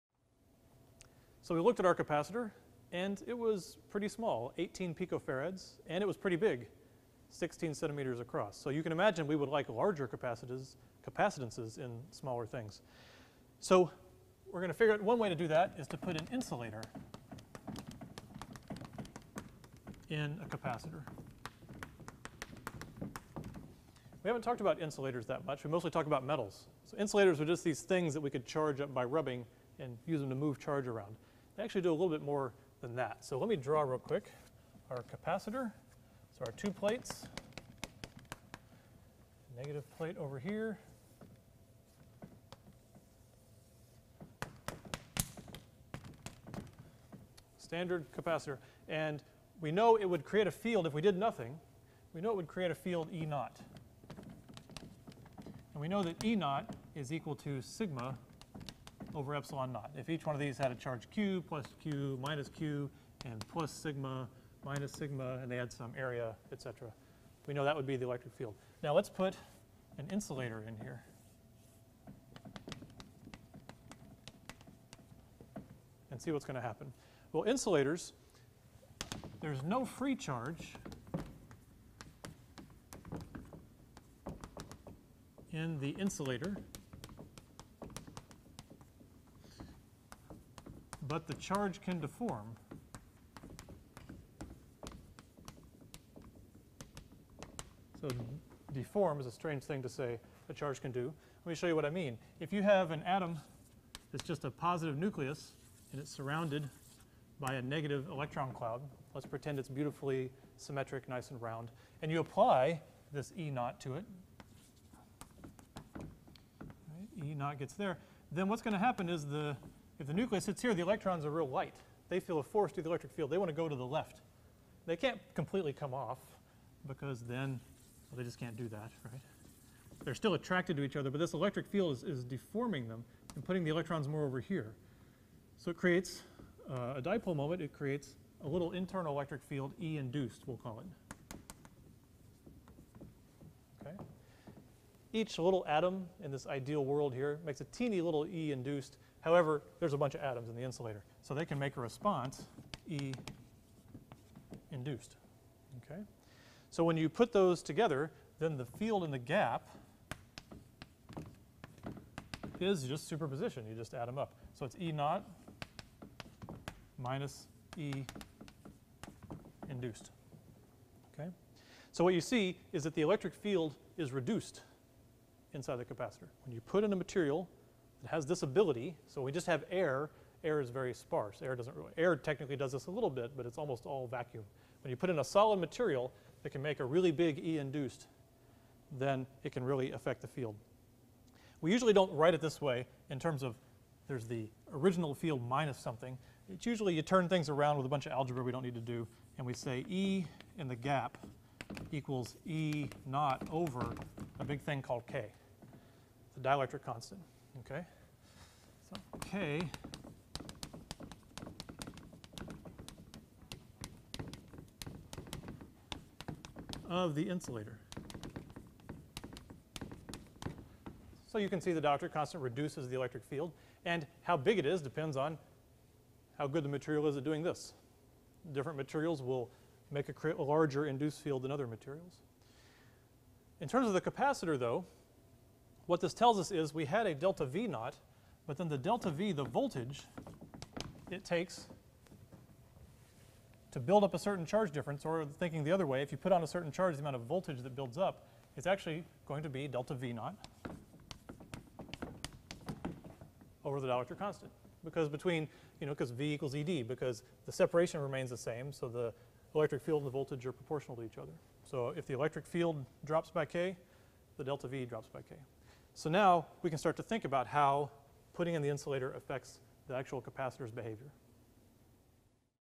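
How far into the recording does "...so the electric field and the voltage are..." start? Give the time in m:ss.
4:18.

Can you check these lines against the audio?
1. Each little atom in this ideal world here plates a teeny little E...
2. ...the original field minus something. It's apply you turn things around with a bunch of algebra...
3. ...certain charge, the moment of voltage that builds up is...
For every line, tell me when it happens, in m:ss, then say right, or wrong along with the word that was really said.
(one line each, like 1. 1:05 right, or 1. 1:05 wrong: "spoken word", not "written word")
1. 2:25 wrong: "makes", not "plates"
2. 3:14 wrong: "usually", not "apply"
3. 4:06 wrong: "amount", not "moment".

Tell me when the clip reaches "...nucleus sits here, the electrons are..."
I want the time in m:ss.
2:00.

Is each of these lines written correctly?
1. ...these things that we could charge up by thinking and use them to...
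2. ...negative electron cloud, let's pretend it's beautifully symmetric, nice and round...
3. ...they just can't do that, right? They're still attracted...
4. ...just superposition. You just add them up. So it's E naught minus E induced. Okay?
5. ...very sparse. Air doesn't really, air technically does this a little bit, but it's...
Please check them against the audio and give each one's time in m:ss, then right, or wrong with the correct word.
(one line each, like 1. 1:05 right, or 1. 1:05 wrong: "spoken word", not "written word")
1. 0:27 wrong: "rubbing", not "thinking"
2. 1:47 right
3. 2:08 right
4. 2:42 right
5. 3:00 right.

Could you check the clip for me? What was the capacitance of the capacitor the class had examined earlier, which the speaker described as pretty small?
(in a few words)
18 picofarads.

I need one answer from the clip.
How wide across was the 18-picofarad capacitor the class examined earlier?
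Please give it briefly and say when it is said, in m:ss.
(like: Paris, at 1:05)
16 centimeters, at 0:07.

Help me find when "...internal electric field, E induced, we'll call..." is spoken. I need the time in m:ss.
2:18.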